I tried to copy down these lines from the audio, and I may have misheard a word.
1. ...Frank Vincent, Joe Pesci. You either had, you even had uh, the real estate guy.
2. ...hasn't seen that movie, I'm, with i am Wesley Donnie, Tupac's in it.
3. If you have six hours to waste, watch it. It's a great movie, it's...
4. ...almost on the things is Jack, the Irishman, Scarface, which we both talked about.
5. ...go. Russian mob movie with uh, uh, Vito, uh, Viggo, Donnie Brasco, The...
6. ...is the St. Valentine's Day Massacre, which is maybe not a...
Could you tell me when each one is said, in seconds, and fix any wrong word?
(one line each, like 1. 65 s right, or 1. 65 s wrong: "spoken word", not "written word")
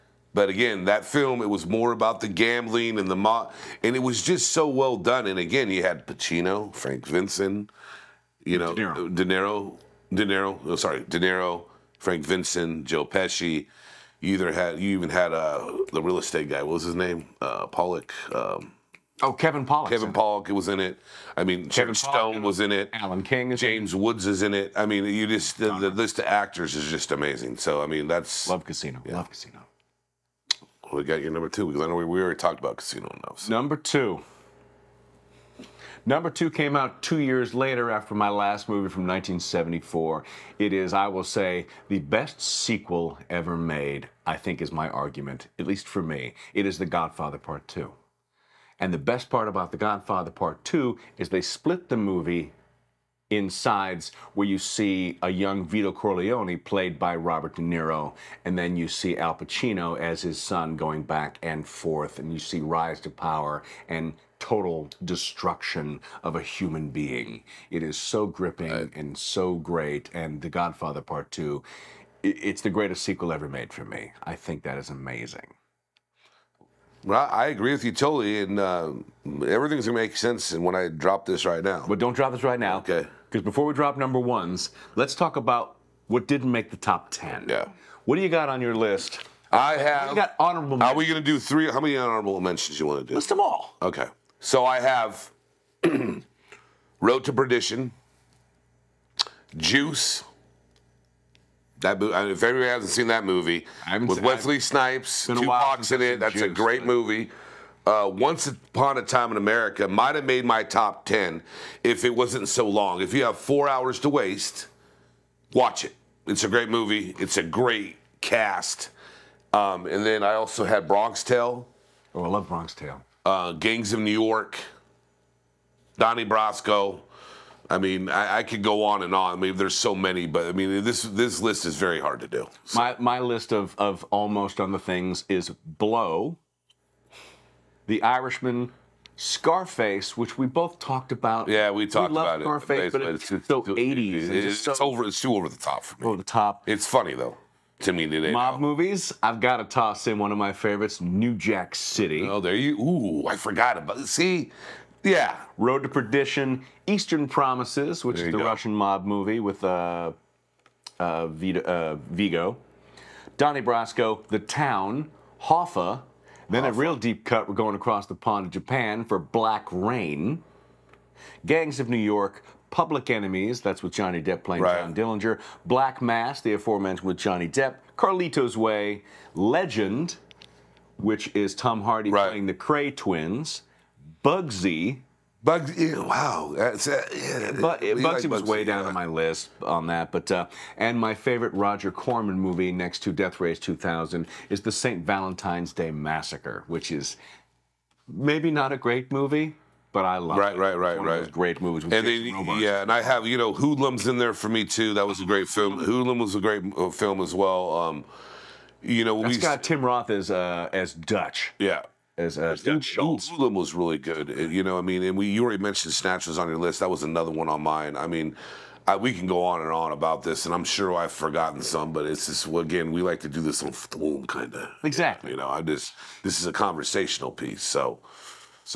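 1. 11 s right
2. 102 s wrong: "Snipes", not "Donnie"
3. 113 s wrong: "four", not "six"
4. 134 s wrong: "Blow", not "Jack"
5. 158 s right
6. 194 s right.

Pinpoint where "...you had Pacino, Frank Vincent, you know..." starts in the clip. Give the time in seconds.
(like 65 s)
5 s.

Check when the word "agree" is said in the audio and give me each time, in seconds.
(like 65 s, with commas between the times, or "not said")
77 s.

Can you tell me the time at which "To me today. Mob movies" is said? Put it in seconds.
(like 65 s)
147 s.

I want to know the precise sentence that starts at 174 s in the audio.
John Dillinger, Black Mass, the aforementioned with Johnny Depp, Carlito's Way, Legend, which is Tom Hardy right.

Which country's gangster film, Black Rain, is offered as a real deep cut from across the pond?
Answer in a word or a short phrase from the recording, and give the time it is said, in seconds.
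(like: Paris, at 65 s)
Japan, at 168 s.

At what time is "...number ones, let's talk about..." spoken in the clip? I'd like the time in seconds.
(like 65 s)
83 s.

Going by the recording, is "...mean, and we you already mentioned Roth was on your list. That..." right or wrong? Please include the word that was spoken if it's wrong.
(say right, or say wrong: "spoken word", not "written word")
wrong: "Snatch", not "Roth".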